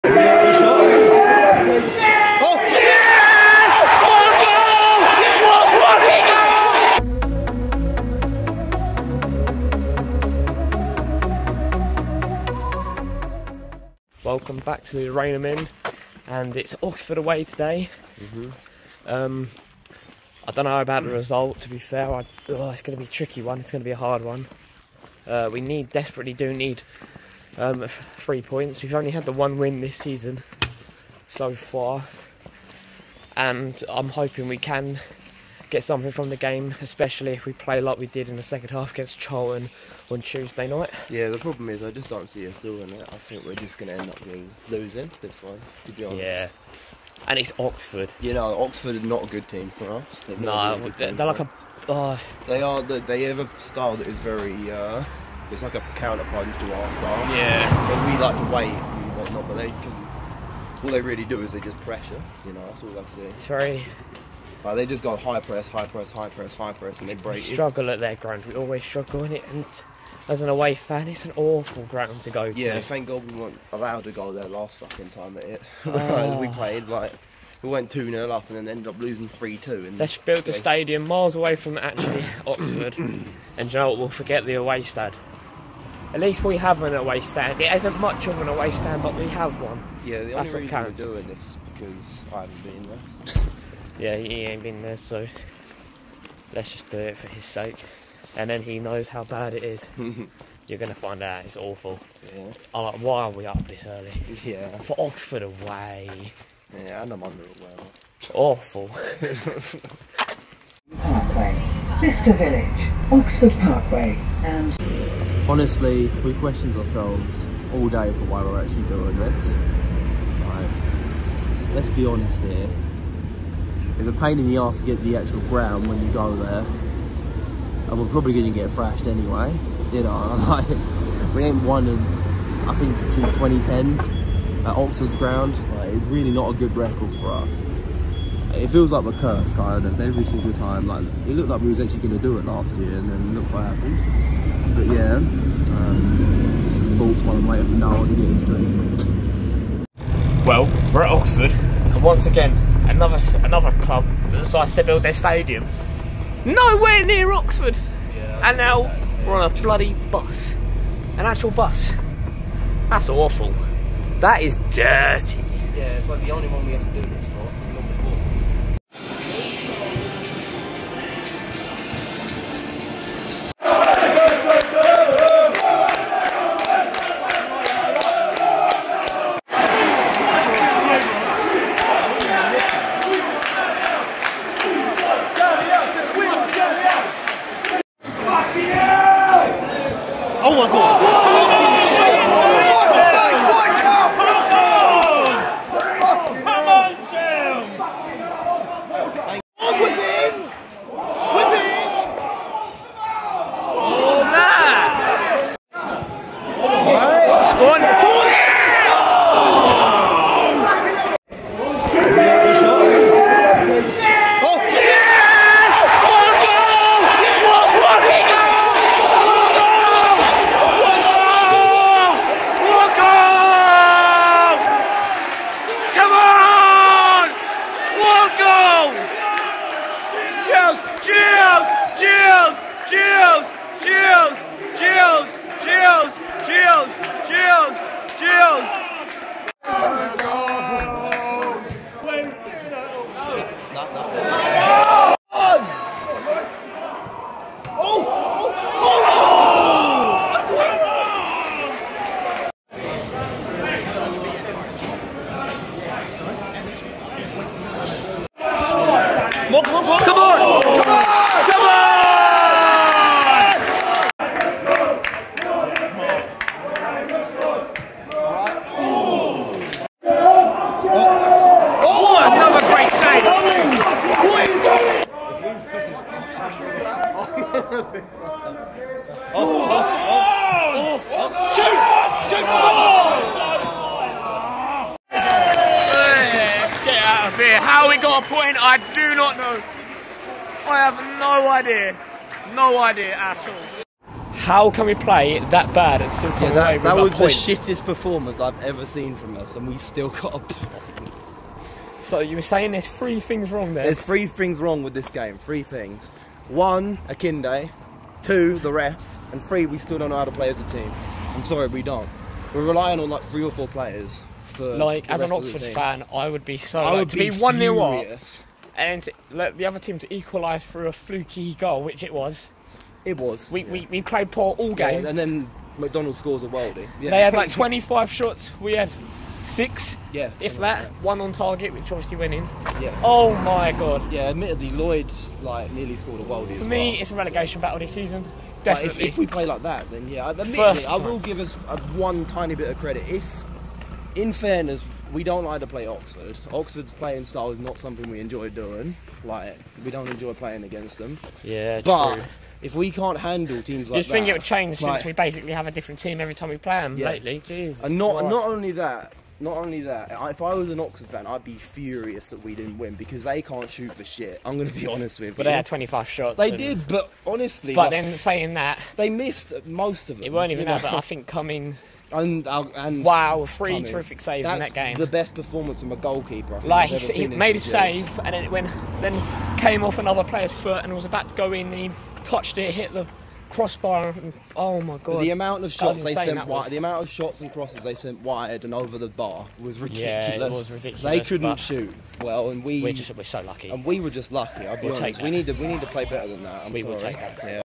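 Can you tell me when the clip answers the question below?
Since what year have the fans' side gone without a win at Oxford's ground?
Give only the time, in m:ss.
2:13.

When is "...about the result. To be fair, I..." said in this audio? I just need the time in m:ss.
0:20.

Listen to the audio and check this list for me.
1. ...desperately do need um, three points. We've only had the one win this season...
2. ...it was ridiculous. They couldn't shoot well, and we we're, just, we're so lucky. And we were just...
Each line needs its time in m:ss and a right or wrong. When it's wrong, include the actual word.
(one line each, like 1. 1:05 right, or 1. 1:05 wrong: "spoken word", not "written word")
1. 0:25 right
2. 6:30 right.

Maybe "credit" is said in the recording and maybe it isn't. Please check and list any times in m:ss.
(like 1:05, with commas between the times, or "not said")
5:42.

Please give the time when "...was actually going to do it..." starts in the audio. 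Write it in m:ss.
2:21.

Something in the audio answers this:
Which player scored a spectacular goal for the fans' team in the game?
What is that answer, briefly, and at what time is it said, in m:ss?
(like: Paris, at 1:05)
McDonald, at 5:25.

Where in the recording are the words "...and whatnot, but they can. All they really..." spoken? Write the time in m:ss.
0:58.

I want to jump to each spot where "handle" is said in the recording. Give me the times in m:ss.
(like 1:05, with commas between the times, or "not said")
5:53.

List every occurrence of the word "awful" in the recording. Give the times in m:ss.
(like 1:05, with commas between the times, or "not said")
1:11, 1:41, 1:48, 2:43.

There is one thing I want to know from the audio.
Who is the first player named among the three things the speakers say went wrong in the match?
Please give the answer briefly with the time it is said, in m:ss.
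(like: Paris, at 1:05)
Akinde, at 5:07.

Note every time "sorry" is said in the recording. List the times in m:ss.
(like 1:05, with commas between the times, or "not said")
5:11, 6:36.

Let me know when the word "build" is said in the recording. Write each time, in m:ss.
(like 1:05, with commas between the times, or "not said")
1:20, 2:34.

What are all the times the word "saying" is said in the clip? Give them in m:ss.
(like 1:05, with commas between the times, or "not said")
5:02, 6:08.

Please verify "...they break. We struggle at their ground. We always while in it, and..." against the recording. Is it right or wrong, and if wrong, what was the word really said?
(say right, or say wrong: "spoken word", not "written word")
wrong: "struggle", not "while".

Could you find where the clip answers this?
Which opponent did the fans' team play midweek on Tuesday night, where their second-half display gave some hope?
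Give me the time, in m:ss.
0:39.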